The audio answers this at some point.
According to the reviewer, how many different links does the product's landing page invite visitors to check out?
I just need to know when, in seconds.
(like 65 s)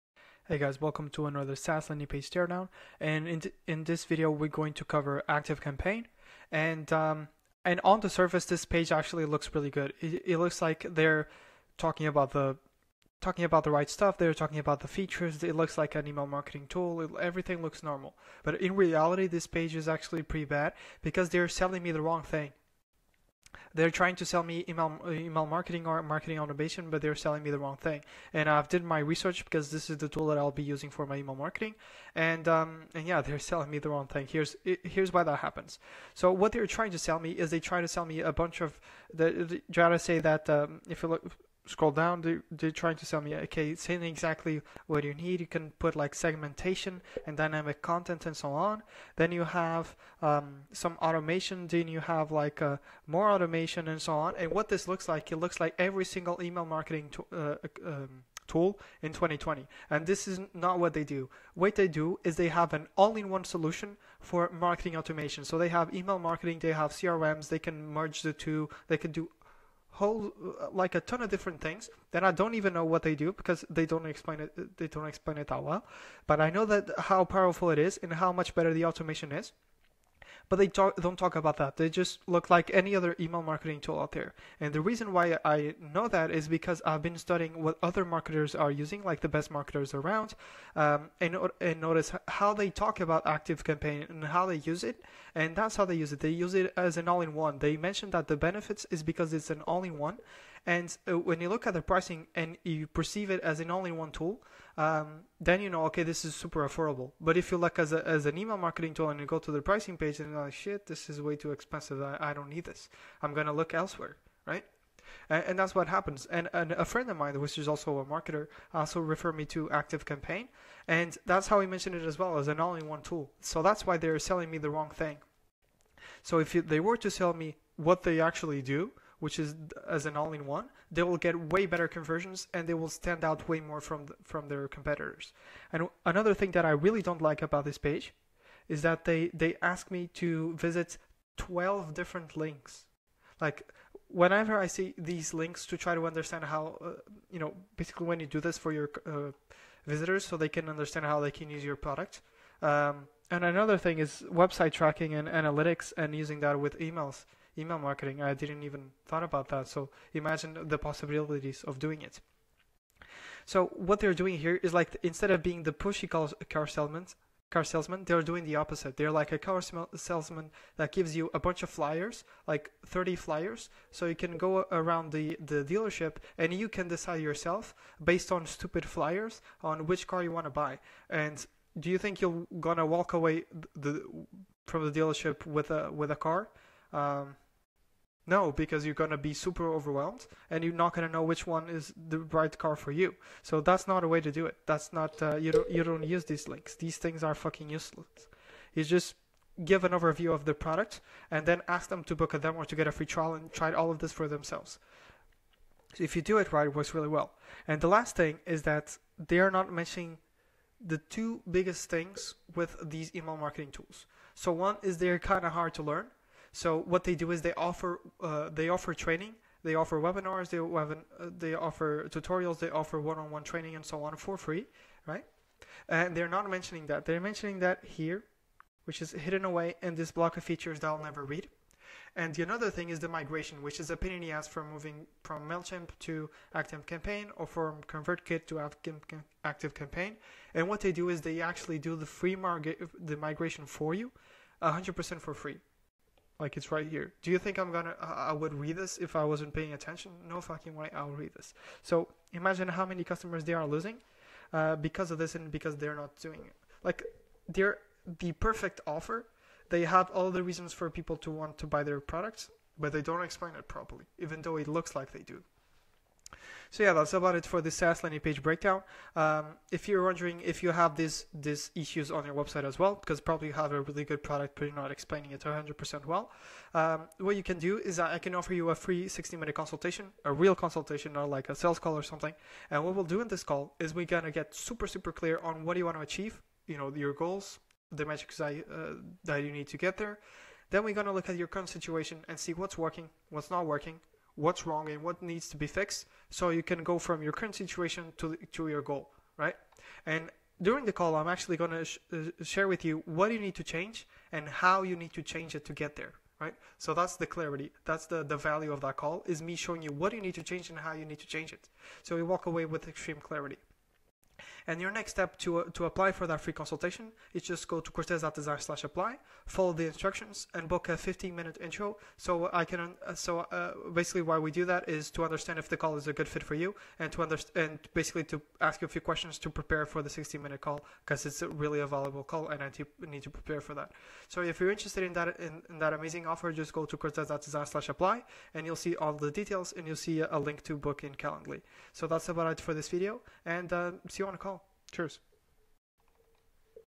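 141 s.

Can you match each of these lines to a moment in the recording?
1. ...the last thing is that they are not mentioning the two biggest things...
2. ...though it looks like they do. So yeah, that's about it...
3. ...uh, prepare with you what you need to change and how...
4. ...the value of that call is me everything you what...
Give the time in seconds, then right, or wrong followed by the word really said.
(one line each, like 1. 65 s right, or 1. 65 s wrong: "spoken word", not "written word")
1. 207 s right
2. 264 s right
3. 302 s wrong: "share", not "prepare"
4. 308 s wrong: "showing", not "everything".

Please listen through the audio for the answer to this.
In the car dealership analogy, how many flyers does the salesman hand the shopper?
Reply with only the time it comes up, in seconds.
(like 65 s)
172 s.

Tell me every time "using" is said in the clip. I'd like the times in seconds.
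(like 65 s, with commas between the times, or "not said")
30 s, 88 s, 156 s.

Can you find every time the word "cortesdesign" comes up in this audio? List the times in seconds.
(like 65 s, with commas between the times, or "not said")
317 s, 336 s.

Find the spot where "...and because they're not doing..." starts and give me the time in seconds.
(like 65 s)
255 s.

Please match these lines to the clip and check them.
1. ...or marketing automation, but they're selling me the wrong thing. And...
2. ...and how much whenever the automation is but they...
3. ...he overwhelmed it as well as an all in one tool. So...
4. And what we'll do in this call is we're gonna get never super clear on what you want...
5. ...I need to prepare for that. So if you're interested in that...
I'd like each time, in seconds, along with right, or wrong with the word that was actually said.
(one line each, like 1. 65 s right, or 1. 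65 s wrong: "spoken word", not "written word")
1. 25 s right
2. 77 s wrong: "better", not "whenever"
3. 121 s wrong: "mentioned", not "overwhelmed"
4. 282 s wrong: "super", not "never"
5. 332 s right.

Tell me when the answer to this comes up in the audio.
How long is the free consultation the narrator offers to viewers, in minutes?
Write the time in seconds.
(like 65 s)
279 s.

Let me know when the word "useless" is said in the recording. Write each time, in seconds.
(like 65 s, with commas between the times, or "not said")
197 s.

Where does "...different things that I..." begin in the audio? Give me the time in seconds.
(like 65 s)
71 s.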